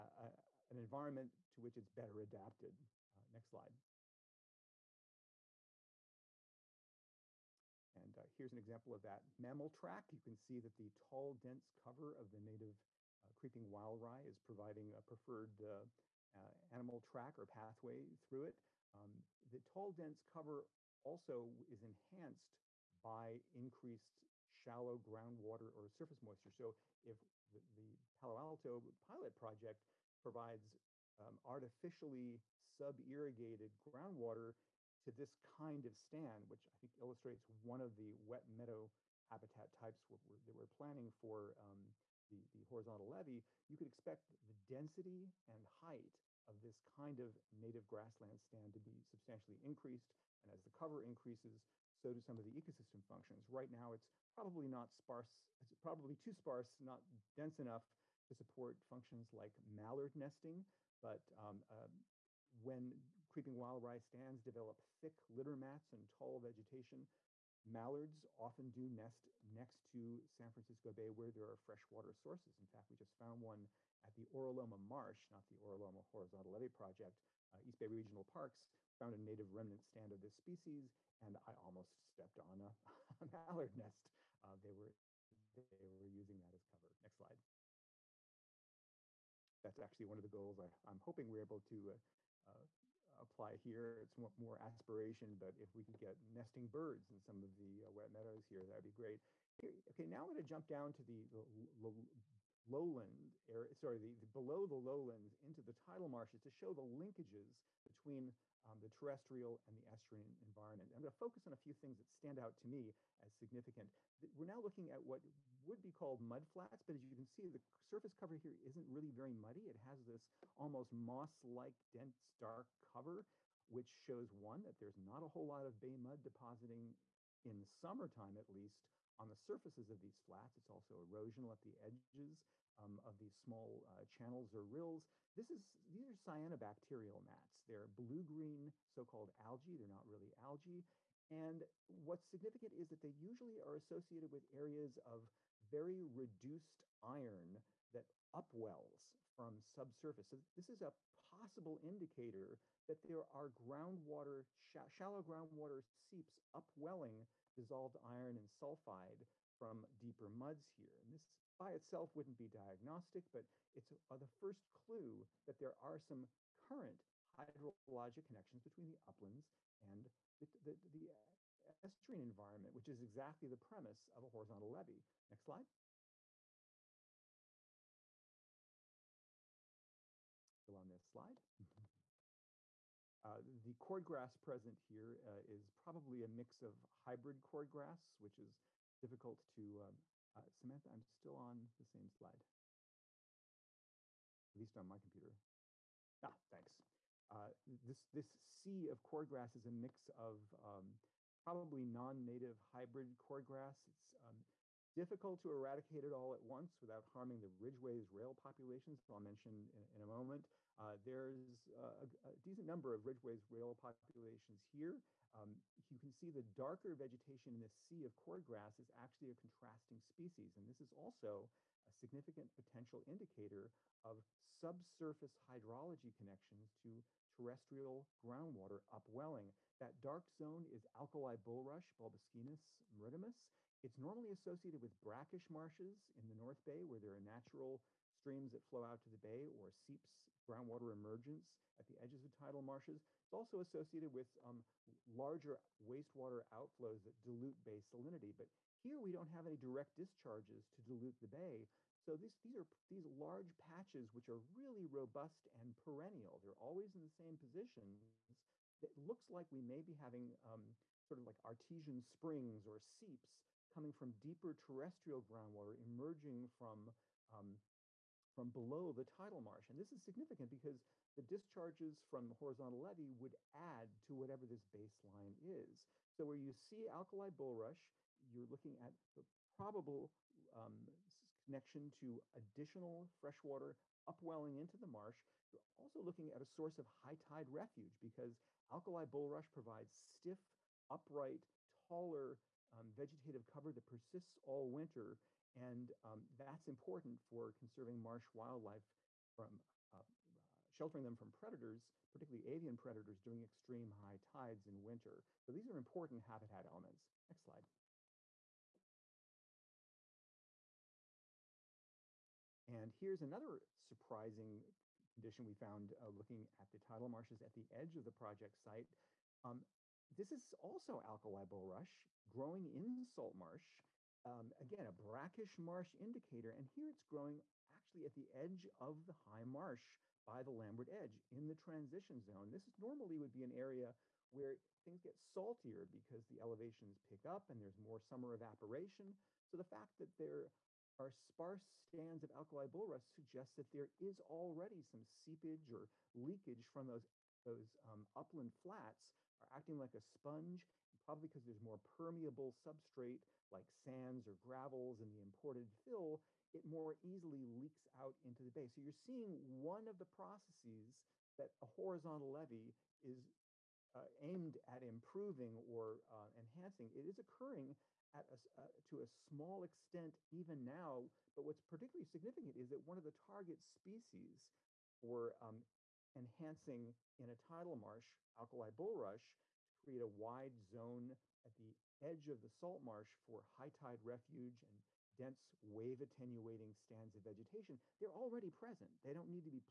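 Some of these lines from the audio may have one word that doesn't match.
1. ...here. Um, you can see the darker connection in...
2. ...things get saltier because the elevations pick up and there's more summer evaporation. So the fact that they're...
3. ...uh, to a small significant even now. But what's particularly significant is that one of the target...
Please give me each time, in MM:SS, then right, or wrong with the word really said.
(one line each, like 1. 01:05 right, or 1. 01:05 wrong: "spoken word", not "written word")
1. 03:34 wrong: "vegetation", not "connection"
2. 05:34 right
3. 06:08 wrong: "extent", not "significant".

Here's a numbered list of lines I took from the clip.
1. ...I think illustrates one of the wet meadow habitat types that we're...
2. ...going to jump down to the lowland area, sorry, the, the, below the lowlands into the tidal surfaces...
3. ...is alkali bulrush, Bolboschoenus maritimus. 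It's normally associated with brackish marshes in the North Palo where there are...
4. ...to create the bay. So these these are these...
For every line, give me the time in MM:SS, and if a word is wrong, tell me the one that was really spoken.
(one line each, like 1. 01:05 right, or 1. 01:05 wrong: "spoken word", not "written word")
1. 00:36 right
2. 01:40 wrong: "marshes", not "surfaces"
3. 03:50 wrong: "Bay", not "Palo"
4. 04:10 wrong: "dilute", not "create".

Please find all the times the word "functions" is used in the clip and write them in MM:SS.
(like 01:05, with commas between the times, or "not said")
00:53, 00:58.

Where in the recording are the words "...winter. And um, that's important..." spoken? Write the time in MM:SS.
04:54.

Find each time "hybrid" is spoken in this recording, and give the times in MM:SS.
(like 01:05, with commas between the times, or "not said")
03:06, 03:22.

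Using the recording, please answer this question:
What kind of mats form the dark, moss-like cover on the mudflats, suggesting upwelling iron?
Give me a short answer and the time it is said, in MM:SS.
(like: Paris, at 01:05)
Cyanobacterial mats, at 02:16.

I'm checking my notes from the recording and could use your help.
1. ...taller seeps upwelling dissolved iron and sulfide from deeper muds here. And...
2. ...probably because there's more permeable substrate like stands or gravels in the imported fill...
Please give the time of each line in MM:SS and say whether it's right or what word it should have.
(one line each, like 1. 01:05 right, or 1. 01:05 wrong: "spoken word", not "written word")
1. 02:35 wrong: "groundwater", not "taller"
2. 05:50 wrong: "sands", not "stands".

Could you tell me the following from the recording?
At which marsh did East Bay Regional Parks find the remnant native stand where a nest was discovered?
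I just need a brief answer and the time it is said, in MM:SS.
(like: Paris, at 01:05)
Oro Loma Marsh, at 01:14.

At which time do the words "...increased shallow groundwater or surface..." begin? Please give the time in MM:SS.
00:23.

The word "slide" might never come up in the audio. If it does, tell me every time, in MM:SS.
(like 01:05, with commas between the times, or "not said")
00:03, 01:27, 02:55, 03:01, 03:12, 05:07.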